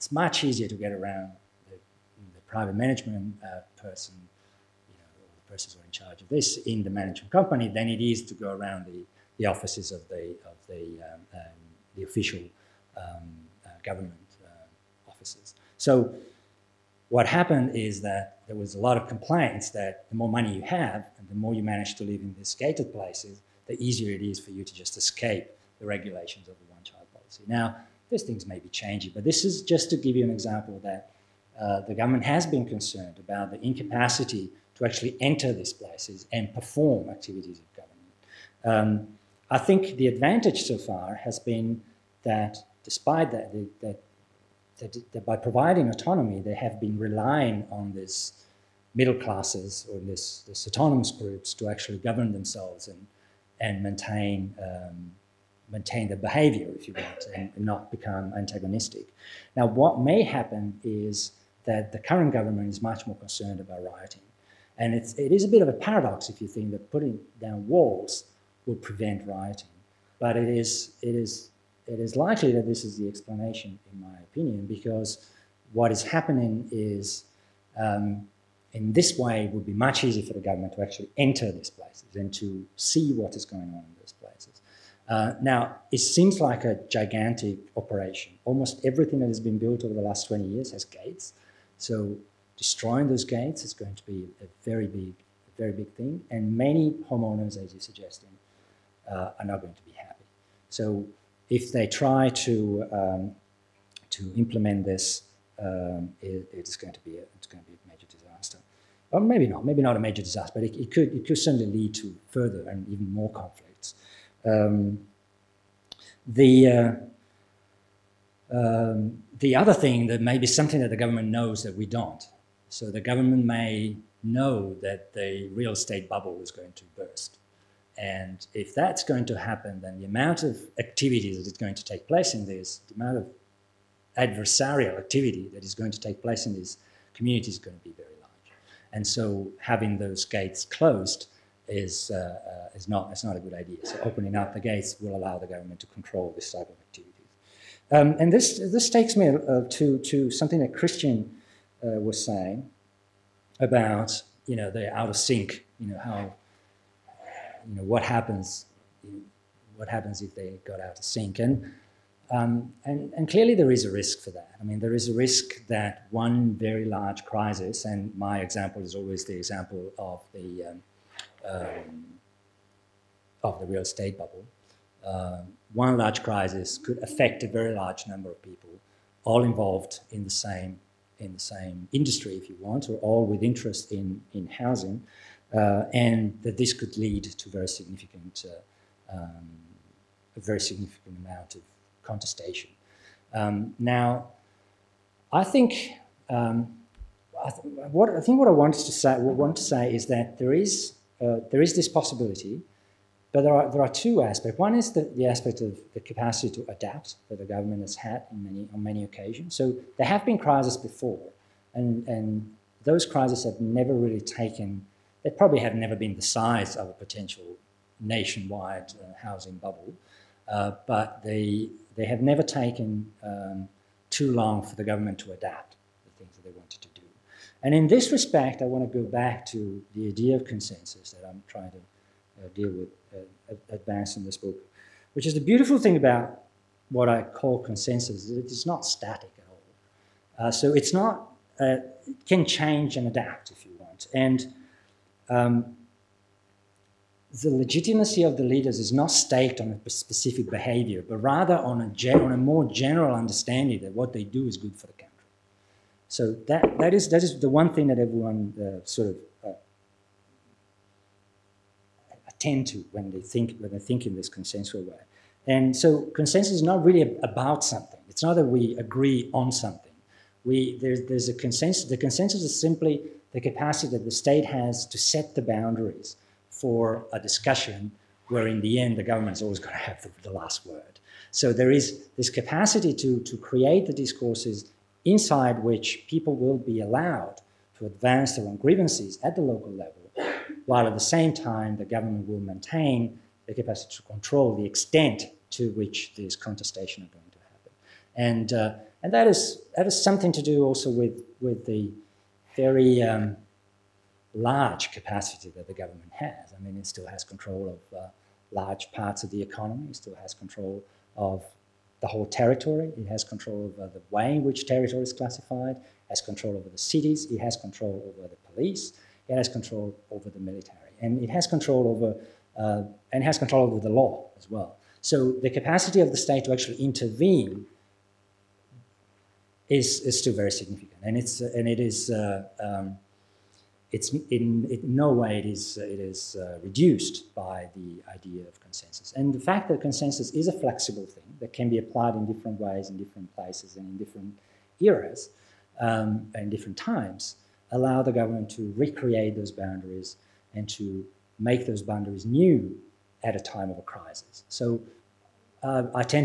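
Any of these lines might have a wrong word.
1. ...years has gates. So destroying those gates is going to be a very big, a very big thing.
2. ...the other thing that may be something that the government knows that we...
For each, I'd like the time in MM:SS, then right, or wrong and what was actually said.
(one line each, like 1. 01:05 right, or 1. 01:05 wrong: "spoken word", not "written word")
1. 01:30 right
2. 01:59 right.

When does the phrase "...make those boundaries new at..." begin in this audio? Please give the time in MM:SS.
05:51.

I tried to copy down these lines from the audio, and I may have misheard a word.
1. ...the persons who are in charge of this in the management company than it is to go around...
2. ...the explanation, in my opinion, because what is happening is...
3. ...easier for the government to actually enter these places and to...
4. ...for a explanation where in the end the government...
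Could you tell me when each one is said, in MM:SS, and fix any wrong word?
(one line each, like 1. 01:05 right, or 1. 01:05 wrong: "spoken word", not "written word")
1. 00:05 right
2. 01:12 right
3. 01:20 right
4. 04:36 wrong: "discussion", not "explanation".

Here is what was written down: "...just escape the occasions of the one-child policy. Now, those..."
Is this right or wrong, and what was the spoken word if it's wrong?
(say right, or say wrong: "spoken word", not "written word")
wrong: "regulations", not "occasions".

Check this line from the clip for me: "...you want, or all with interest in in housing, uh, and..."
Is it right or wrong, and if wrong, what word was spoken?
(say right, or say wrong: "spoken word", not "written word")
right.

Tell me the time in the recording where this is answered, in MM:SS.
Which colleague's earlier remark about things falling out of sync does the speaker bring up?
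02:30.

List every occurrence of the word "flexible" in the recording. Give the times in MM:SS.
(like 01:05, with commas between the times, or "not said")
05:40.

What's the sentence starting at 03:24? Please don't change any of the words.
One is the, the aspect of the capacity to adapt that the government has had in many on many occasions.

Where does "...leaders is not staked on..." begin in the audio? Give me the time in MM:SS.
04:08.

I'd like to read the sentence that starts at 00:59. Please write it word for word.
Now, what may happen is that the current government is much more concerned about rioting.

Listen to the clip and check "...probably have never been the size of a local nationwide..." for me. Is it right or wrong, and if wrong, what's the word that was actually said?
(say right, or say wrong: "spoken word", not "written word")
wrong: "potential", not "local".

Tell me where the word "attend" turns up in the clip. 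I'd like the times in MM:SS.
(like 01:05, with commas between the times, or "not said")
04:22.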